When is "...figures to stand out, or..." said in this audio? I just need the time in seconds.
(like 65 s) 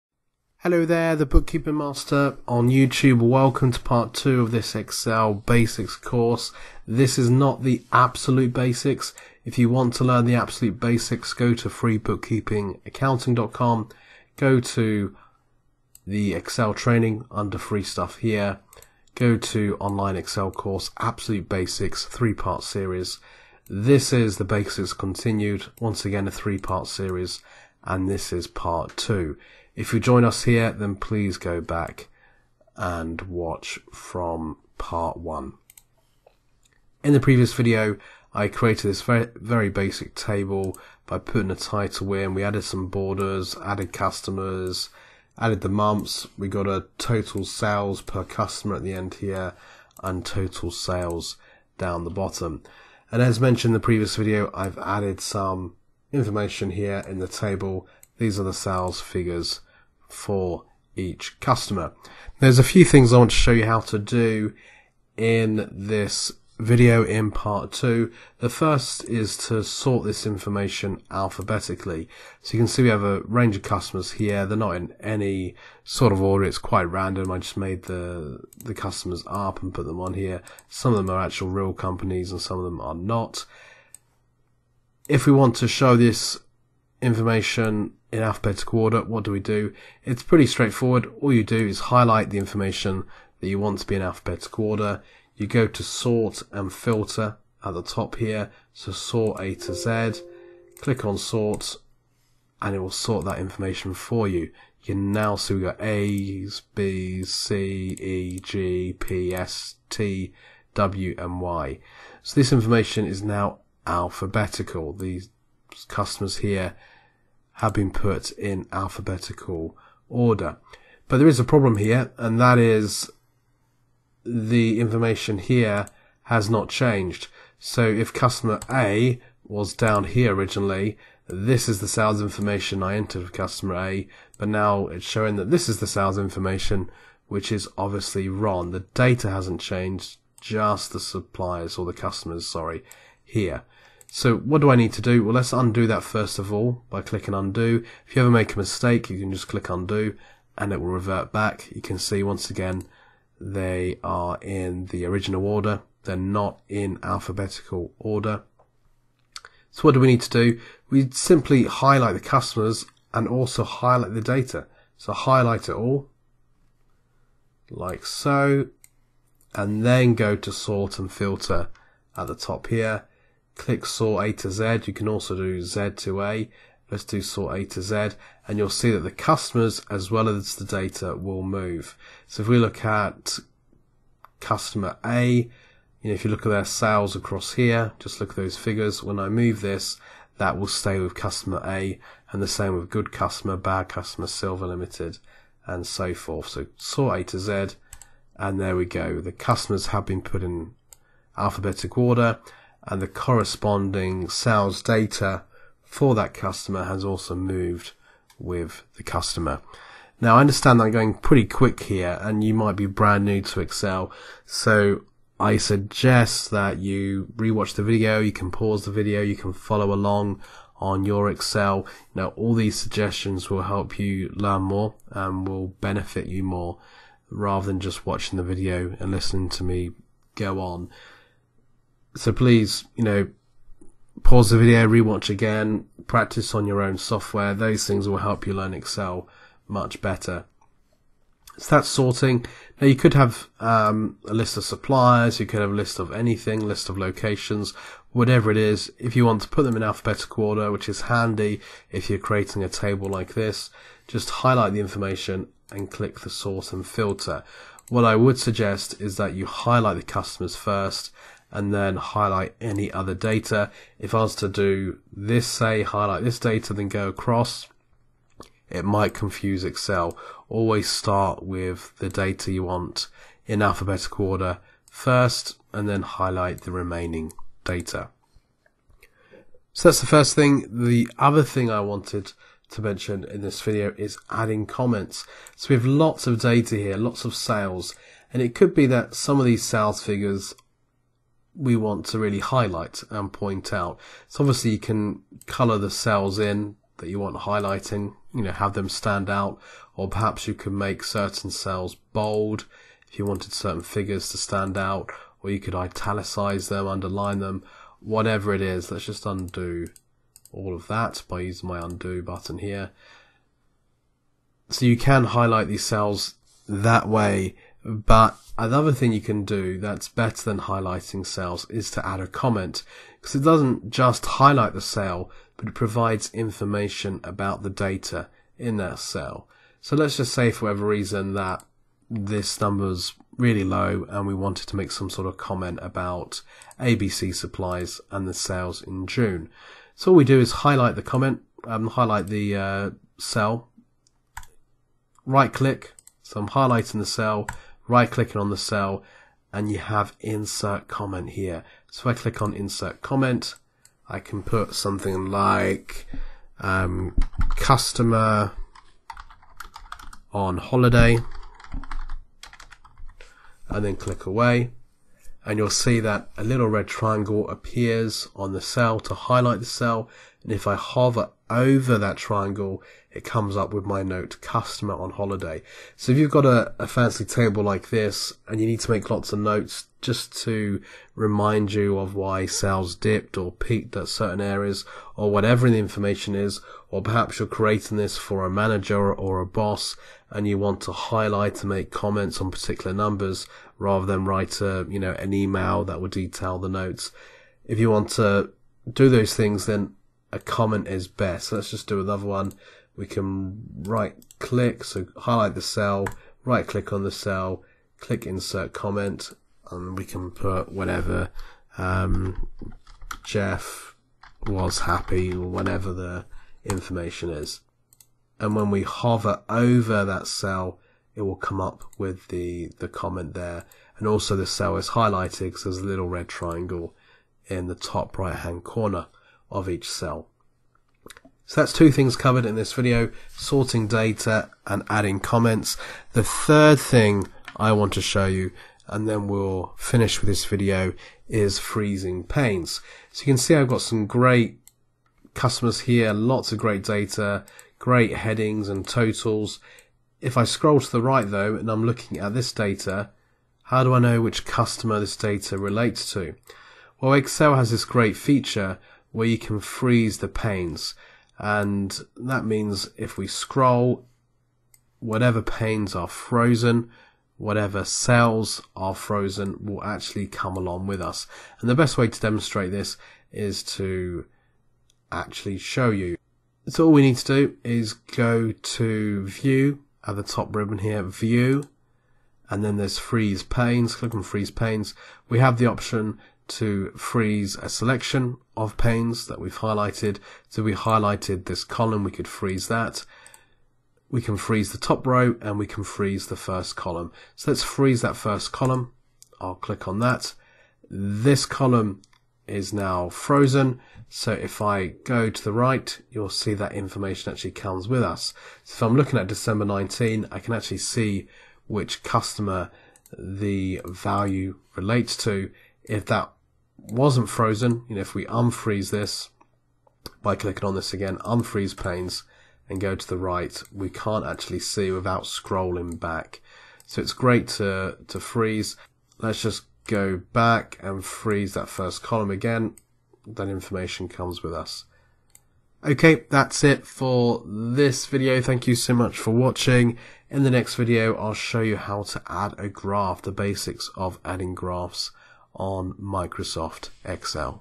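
303 s.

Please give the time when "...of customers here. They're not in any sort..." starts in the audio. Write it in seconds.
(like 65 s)
73 s.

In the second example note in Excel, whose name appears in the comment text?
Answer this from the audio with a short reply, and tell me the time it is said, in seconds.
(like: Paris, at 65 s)
Jeff, at 413 s.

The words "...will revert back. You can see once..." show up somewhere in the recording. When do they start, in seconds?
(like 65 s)
150 s.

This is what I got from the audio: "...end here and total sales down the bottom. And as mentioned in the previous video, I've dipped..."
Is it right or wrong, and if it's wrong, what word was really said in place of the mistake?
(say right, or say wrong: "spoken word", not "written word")
wrong: "added", not "dipped".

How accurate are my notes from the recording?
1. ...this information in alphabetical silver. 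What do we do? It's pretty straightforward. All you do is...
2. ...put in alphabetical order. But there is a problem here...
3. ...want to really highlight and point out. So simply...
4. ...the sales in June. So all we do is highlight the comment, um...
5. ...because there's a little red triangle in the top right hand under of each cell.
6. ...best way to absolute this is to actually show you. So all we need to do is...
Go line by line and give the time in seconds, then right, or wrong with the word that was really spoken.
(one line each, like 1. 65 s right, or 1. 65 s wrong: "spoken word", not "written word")
1. 85 s wrong: "order", not "silver"
2. 117 s right
3. 291 s wrong: "obviously", not "simply"
4. 338 s right
5. 425 s wrong: "corner", not "under"
6. 471 s wrong: "demonstrate", not "absolute".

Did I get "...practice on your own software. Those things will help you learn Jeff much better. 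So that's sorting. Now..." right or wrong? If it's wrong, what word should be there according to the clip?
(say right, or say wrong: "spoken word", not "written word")
wrong: "Excel", not "Jeff".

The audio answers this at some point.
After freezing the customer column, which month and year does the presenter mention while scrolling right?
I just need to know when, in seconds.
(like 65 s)
509 s.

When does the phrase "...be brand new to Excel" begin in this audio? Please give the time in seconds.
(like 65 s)
212 s.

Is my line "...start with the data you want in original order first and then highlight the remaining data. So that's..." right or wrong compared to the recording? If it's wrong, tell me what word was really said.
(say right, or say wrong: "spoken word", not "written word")
wrong: "alphabetical", not "original".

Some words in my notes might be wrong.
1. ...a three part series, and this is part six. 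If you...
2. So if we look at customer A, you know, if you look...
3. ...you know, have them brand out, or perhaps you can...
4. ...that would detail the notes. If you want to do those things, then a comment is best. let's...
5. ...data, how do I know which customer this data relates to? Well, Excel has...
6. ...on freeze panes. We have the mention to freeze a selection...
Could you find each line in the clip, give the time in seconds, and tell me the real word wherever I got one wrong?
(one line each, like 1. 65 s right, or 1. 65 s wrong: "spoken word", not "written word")
1. 26 s wrong: "two", not "six"
2. 182 s right
3. 298 s wrong: "stand", not "brand"
4. 395 s right
5. 452 s right
6. 484 s wrong: "option", not "mention".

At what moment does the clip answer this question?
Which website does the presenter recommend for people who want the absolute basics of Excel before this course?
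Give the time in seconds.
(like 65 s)
11 s.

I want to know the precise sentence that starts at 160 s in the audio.
We simply highlight the customers and also highlight the data.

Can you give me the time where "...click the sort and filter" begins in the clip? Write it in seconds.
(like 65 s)
255 s.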